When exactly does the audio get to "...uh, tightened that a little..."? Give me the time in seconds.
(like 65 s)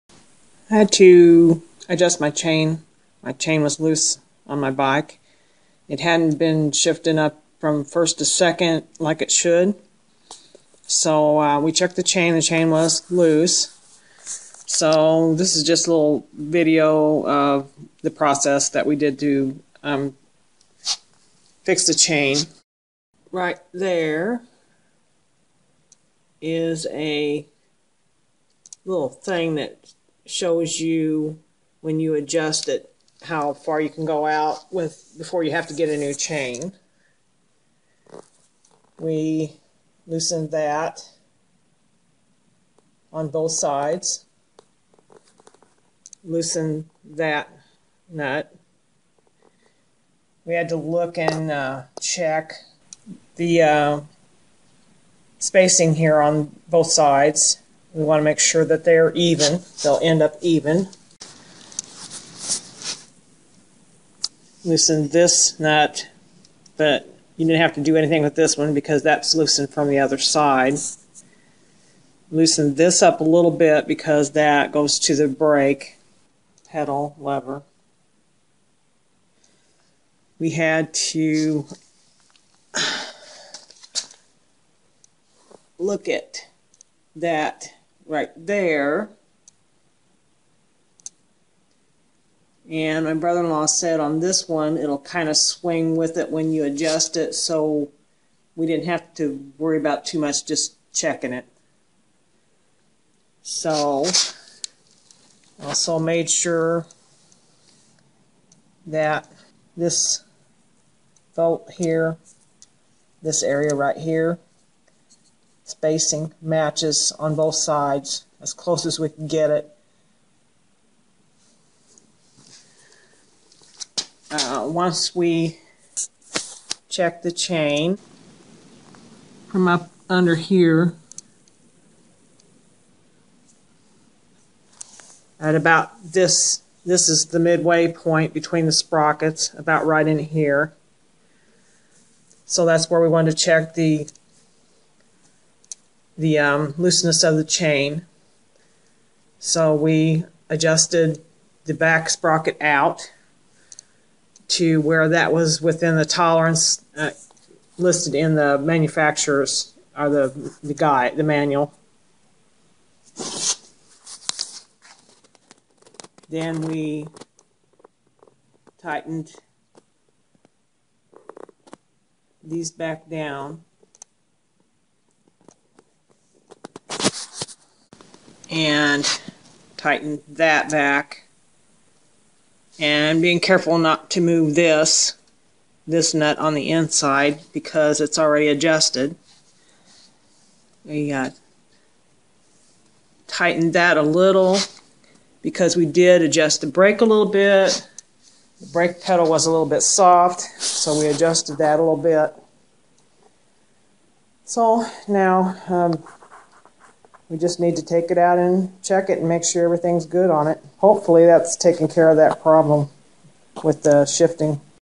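191 s.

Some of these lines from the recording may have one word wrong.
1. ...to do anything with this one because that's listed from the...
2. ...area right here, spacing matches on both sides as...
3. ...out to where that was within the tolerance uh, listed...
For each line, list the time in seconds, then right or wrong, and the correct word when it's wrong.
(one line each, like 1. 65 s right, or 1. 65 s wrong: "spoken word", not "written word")
1. 67 s wrong: "loosened", not "listed"
2. 113 s right
3. 152 s right.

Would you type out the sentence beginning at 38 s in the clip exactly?
We loosened that on both sides.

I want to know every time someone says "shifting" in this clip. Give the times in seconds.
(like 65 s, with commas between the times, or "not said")
6 s, 214 s.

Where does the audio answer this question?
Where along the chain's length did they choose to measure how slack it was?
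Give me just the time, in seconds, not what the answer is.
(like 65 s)
137 s.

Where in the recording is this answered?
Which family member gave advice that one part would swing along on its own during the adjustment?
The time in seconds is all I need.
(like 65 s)
93 s.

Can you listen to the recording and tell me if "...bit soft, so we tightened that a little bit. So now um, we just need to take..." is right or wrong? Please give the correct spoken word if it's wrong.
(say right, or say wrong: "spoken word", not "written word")
wrong: "adjusted", not "tightened".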